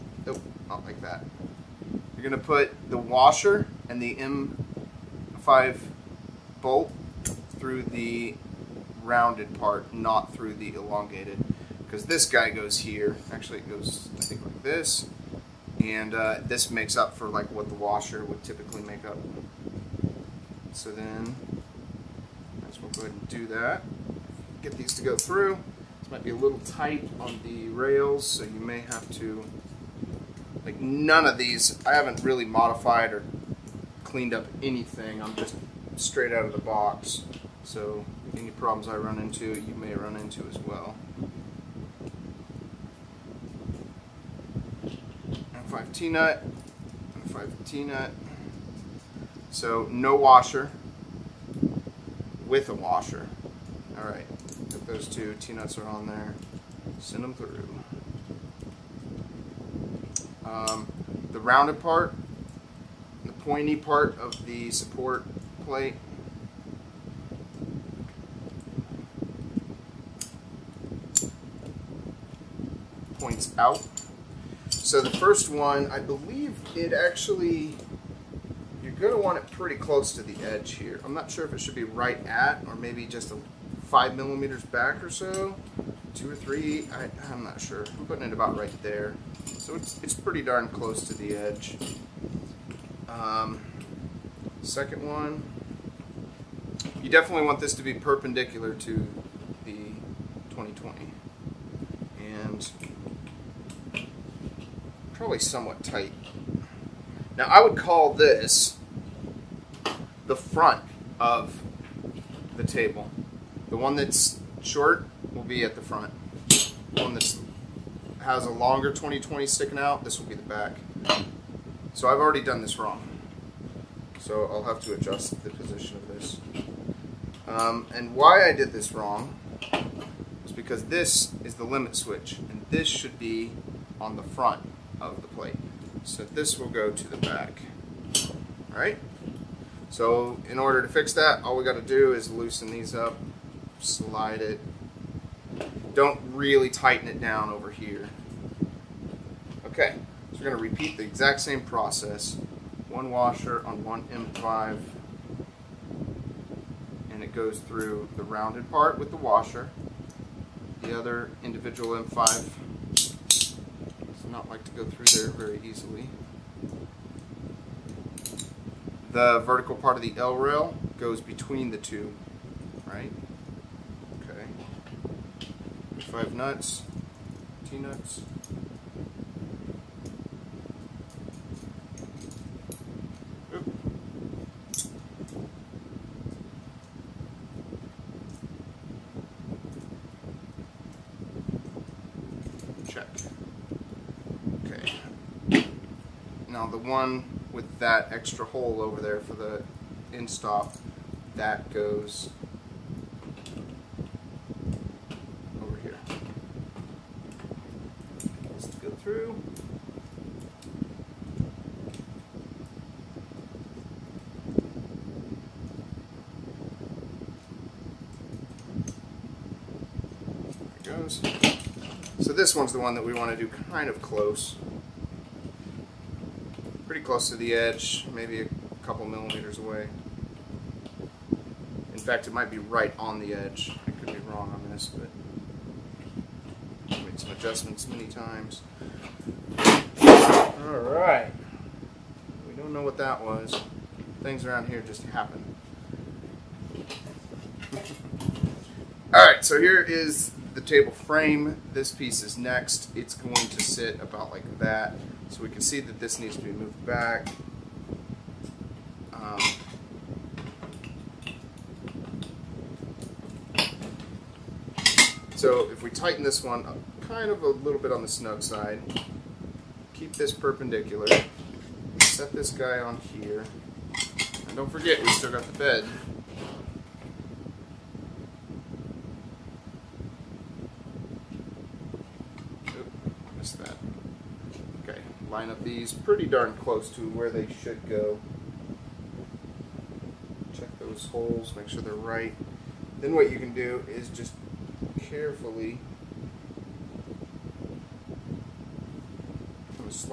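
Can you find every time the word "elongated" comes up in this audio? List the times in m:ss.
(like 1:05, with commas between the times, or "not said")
0:10.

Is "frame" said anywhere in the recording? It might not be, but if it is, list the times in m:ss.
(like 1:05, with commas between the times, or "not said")
4:10.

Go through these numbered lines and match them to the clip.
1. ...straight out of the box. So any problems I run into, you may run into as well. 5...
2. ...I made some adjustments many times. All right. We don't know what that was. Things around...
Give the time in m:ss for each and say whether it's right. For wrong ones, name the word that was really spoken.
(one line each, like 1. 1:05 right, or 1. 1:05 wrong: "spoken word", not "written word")
1. 0:35 right
2. 3:56 right.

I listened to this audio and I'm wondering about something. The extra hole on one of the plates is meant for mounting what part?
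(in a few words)
End stop.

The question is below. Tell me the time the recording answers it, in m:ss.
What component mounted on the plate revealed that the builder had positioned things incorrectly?
2:11.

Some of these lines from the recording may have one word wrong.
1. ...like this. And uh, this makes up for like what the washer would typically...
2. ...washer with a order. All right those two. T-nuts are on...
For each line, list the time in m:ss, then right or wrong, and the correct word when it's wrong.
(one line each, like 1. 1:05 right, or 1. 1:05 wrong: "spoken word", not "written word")
1. 0:14 right
2. 0:50 wrong: "washer", not "order".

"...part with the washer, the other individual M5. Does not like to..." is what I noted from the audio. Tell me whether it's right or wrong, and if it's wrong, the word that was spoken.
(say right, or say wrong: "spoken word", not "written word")
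right.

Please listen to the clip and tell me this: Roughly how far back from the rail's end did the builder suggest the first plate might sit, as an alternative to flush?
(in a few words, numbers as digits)
5 millimeters.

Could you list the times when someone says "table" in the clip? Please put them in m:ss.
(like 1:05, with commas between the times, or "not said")
1:52, 4:10.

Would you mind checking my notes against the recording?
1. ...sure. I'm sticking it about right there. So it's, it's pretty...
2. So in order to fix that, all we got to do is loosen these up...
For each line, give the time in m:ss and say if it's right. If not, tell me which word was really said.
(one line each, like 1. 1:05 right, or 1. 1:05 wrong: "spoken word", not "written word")
1. 1:27 wrong: "putting", not "sticking"
2. 2:19 right.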